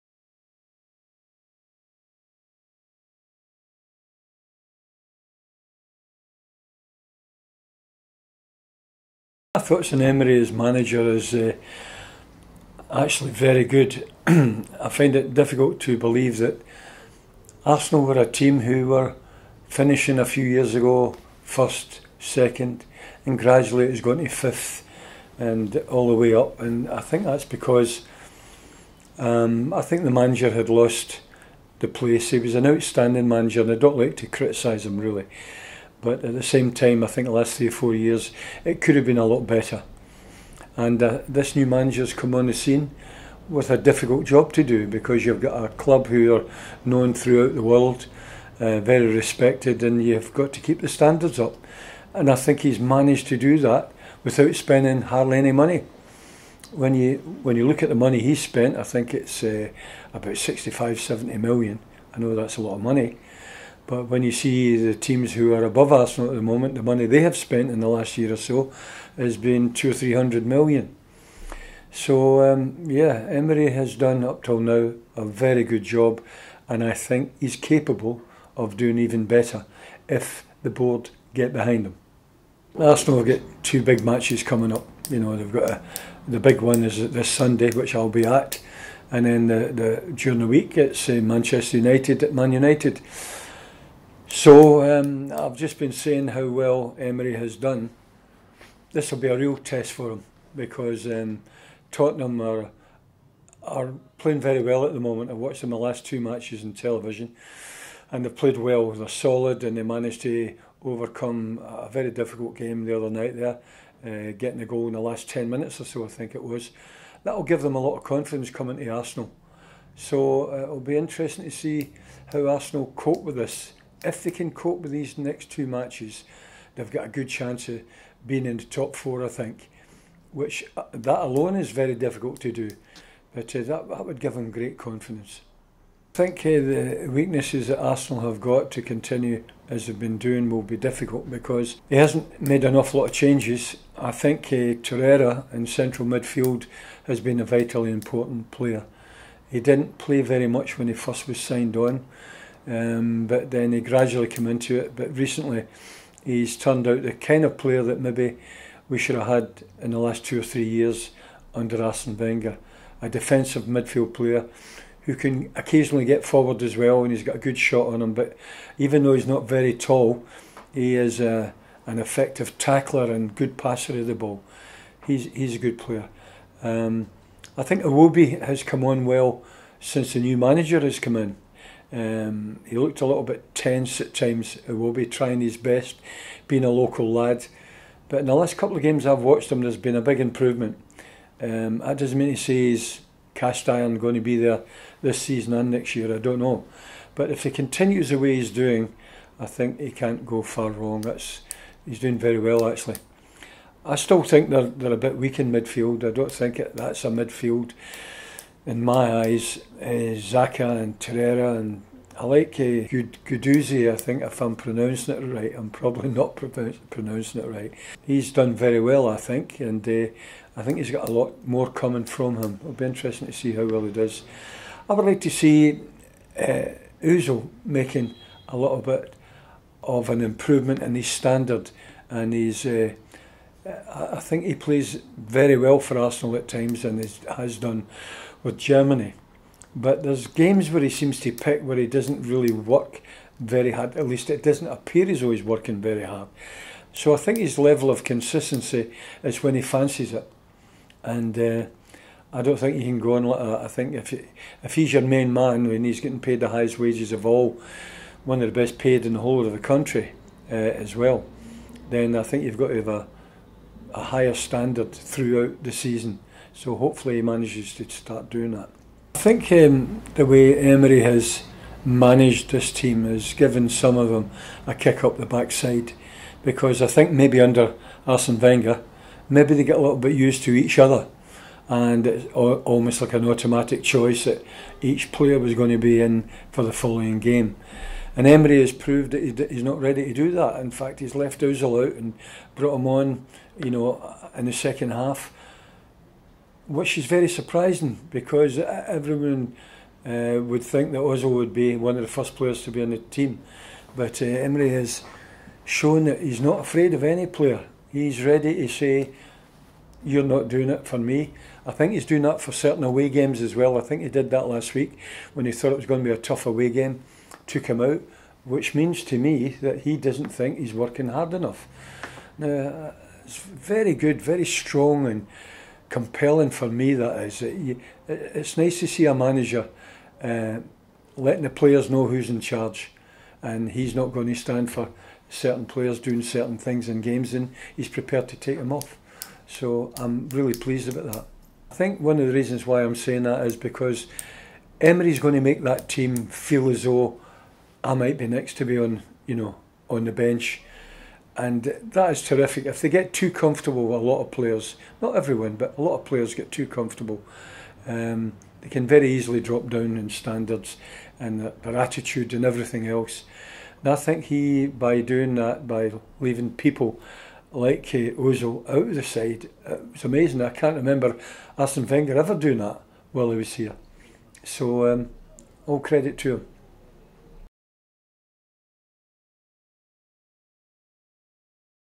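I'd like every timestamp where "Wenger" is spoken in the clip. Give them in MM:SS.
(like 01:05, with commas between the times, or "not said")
02:42, 04:38, 06:11.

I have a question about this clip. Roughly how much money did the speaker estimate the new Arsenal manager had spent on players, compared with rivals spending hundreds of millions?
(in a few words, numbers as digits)
65-70 million.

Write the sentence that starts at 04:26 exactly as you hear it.
So hopefully he manages to start doing that.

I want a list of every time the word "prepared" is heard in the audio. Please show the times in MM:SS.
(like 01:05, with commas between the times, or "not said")
05:37.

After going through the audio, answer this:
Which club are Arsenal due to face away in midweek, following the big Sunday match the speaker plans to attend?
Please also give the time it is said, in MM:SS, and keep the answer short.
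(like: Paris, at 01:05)
Manchester United, at 01:31.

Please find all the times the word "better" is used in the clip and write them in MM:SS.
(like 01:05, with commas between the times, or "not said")
00:39, 01:19.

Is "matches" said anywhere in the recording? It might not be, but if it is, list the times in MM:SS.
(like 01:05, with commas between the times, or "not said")
01:24, 01:46, 02:05.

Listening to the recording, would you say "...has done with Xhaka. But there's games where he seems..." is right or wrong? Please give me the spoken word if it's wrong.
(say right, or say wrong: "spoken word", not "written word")
wrong: "Germany", not "Xhaka".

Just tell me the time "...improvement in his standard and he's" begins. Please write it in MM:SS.
03:50.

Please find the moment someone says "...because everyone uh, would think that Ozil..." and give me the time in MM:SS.
04:58.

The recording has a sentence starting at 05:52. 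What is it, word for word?
If they get too comfortable, a lot of players, not everyone, but a lot of players get too comfortable.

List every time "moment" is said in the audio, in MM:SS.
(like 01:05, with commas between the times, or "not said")
01:06, 01:45.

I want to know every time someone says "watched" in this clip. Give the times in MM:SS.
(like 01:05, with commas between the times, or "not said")
01:45, 03:09.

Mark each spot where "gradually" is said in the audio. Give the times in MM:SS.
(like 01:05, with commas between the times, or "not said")
00:23, 02:33.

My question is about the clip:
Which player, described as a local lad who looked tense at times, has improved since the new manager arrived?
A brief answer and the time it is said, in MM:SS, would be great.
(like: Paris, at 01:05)
Iwobi, at 02:57.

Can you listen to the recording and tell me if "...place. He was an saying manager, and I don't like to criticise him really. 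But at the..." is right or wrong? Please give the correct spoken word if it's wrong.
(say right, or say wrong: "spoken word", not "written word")
wrong: "outstanding", not "saying".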